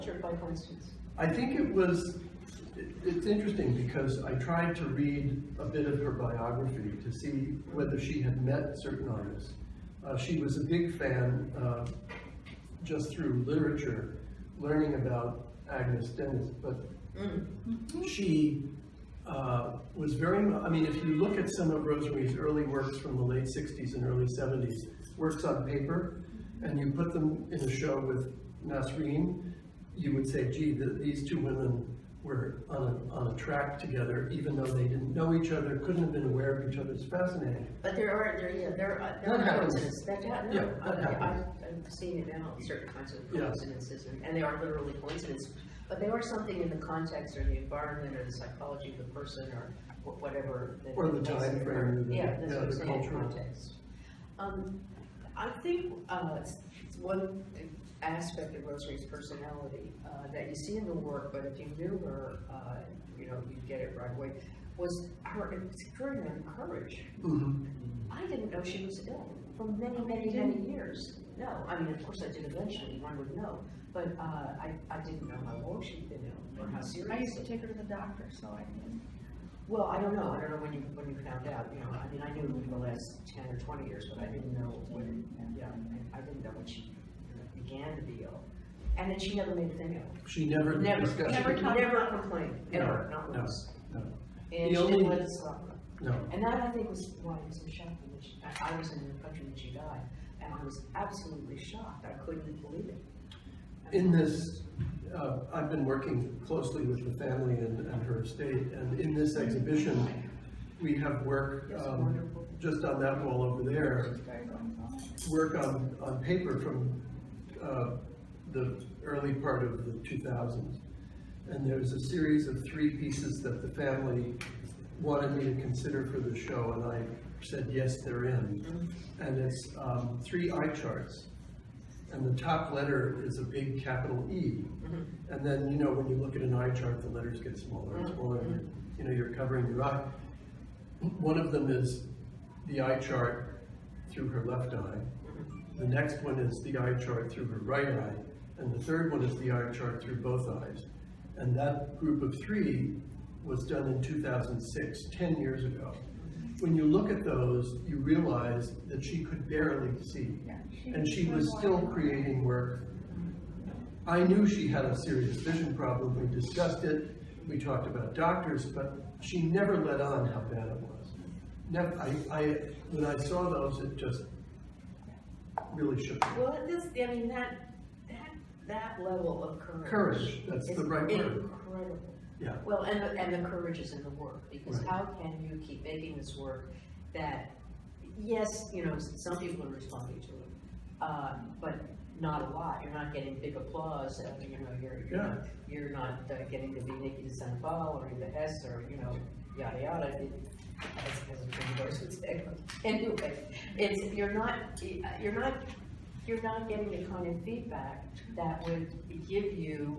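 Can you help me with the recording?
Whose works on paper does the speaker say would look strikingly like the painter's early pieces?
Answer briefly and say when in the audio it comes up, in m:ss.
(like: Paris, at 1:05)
Nasreen, at 0:28.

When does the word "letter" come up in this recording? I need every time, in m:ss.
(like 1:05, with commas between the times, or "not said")
2:12, 2:17.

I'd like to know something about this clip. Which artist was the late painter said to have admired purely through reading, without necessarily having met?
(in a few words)
Agnes Denes.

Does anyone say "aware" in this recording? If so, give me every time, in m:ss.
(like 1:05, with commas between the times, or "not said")
0:36.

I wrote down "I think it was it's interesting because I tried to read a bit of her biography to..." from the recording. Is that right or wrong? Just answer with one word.
right.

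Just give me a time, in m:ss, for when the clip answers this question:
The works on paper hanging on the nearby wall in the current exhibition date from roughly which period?
1:59.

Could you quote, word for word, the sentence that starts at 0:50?
Or the time frame, the- Yeah, that's yeah, what the cultural.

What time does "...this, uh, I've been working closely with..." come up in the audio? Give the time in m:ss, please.
1:44.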